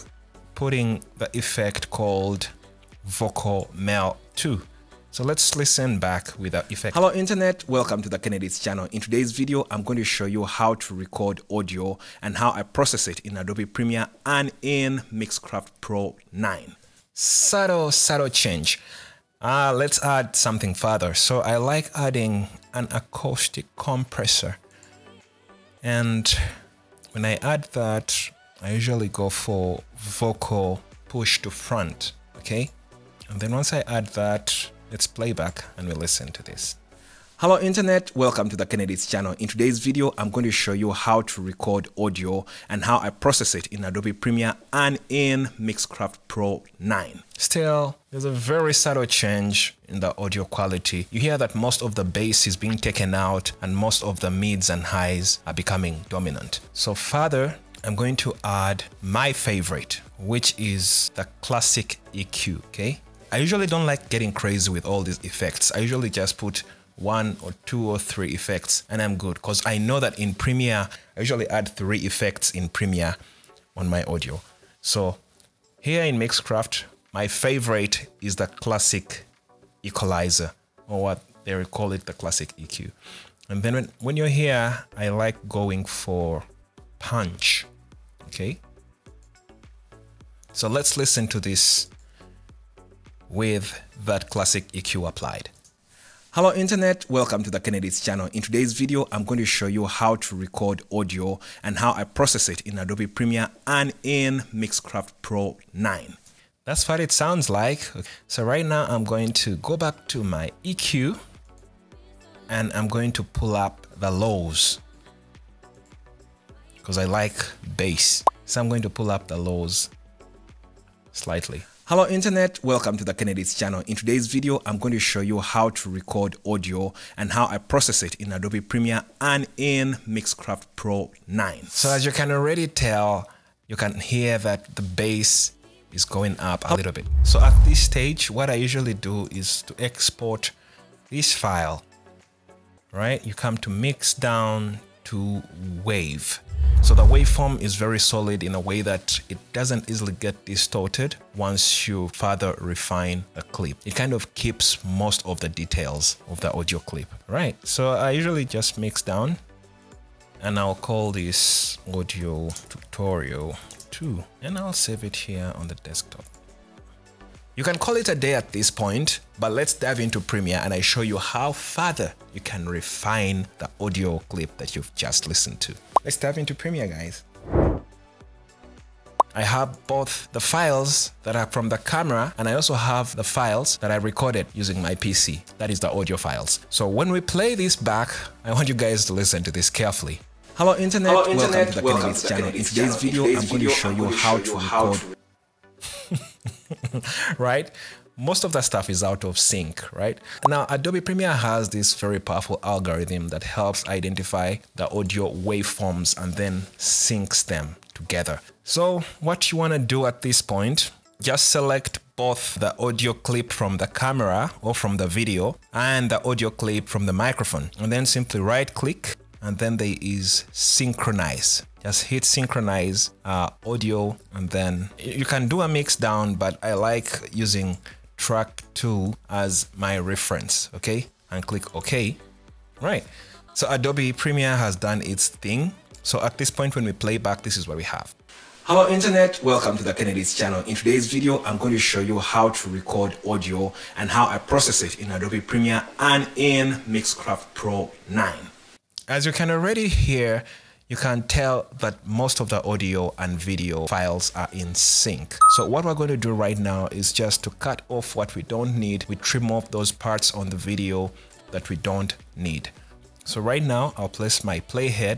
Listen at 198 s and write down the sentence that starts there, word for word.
Most of that stuff is out of sync, right?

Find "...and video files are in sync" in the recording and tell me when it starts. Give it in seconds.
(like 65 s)
253 s.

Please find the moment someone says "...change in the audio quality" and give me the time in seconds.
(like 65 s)
49 s.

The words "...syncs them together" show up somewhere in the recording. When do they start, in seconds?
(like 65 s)
206 s.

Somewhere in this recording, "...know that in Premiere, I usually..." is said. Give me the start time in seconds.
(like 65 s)
69 s.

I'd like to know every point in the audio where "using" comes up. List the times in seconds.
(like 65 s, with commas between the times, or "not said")
184 s, 227 s.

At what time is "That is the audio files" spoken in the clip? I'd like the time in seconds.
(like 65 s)
185 s.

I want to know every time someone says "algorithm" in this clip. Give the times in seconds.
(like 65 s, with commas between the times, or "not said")
202 s.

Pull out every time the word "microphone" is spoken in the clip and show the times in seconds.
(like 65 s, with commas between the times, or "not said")
217 s.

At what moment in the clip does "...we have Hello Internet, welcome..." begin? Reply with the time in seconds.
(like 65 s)
237 s.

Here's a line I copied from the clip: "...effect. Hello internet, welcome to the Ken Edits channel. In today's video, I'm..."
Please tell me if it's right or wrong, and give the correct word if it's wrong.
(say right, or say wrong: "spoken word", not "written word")
right.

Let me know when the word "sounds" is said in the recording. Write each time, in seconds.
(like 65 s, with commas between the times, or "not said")
107 s.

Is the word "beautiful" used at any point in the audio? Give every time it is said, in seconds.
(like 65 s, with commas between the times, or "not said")
not said.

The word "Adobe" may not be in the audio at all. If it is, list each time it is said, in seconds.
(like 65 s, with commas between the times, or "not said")
13 s, 43 s, 102 s, 128 s, 200 s, 233 s, 245 s.